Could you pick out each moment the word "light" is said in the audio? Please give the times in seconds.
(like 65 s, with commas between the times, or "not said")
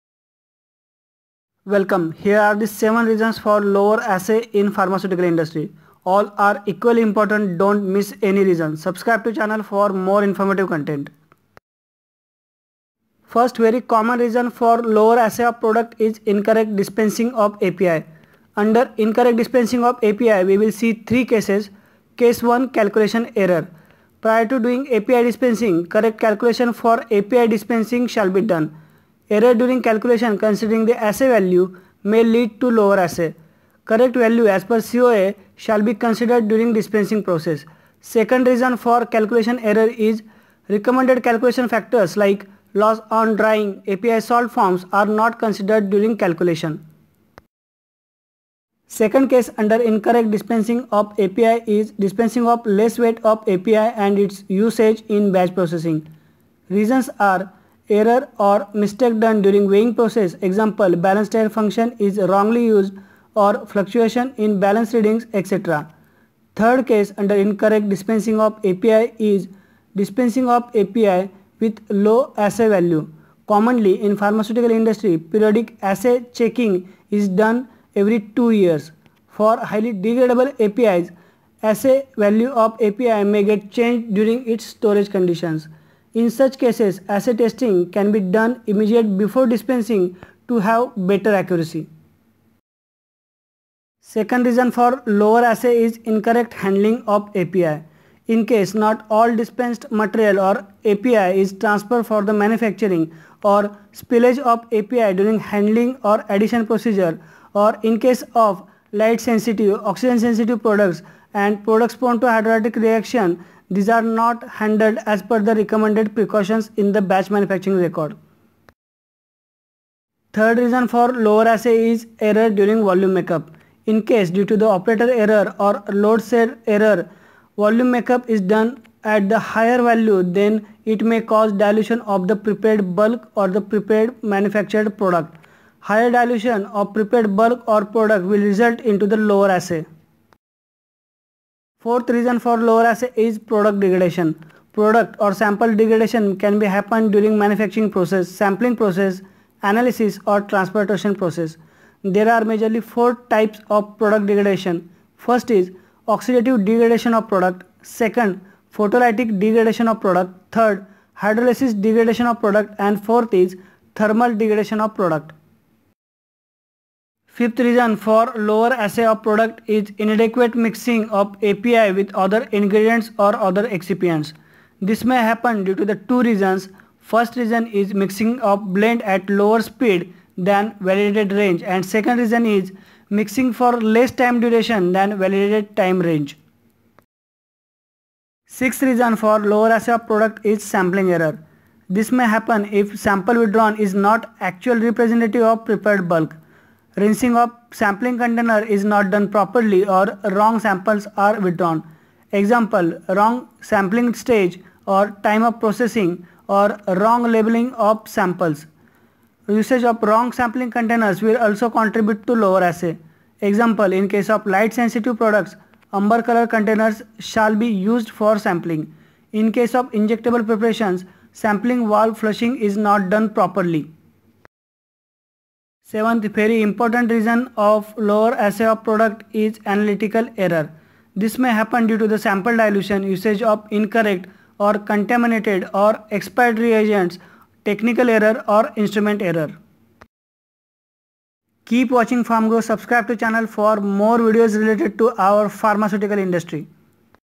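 108 s, 214 s.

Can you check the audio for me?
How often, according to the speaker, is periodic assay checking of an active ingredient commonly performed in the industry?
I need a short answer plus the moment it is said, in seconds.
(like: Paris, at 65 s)
every 2 years, at 77 s.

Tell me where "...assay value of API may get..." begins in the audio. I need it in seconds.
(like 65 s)
81 s.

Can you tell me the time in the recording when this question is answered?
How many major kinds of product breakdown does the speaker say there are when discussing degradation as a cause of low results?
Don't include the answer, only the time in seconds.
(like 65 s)
152 s.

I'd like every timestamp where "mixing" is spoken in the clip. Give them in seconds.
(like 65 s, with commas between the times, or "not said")
170 s, 177 s, 183 s.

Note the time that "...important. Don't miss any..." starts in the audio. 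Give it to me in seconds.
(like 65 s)
7 s.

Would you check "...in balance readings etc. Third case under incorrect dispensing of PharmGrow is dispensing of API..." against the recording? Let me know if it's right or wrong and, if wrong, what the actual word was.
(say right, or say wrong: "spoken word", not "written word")
wrong: "API", not "PharmGrow".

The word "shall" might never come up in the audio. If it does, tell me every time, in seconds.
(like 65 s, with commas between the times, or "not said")
28 s, 35 s, 217 s.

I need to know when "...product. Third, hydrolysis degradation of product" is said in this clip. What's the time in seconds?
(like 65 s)
160 s.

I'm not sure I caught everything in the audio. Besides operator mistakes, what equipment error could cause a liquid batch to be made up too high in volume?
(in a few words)
load cell error.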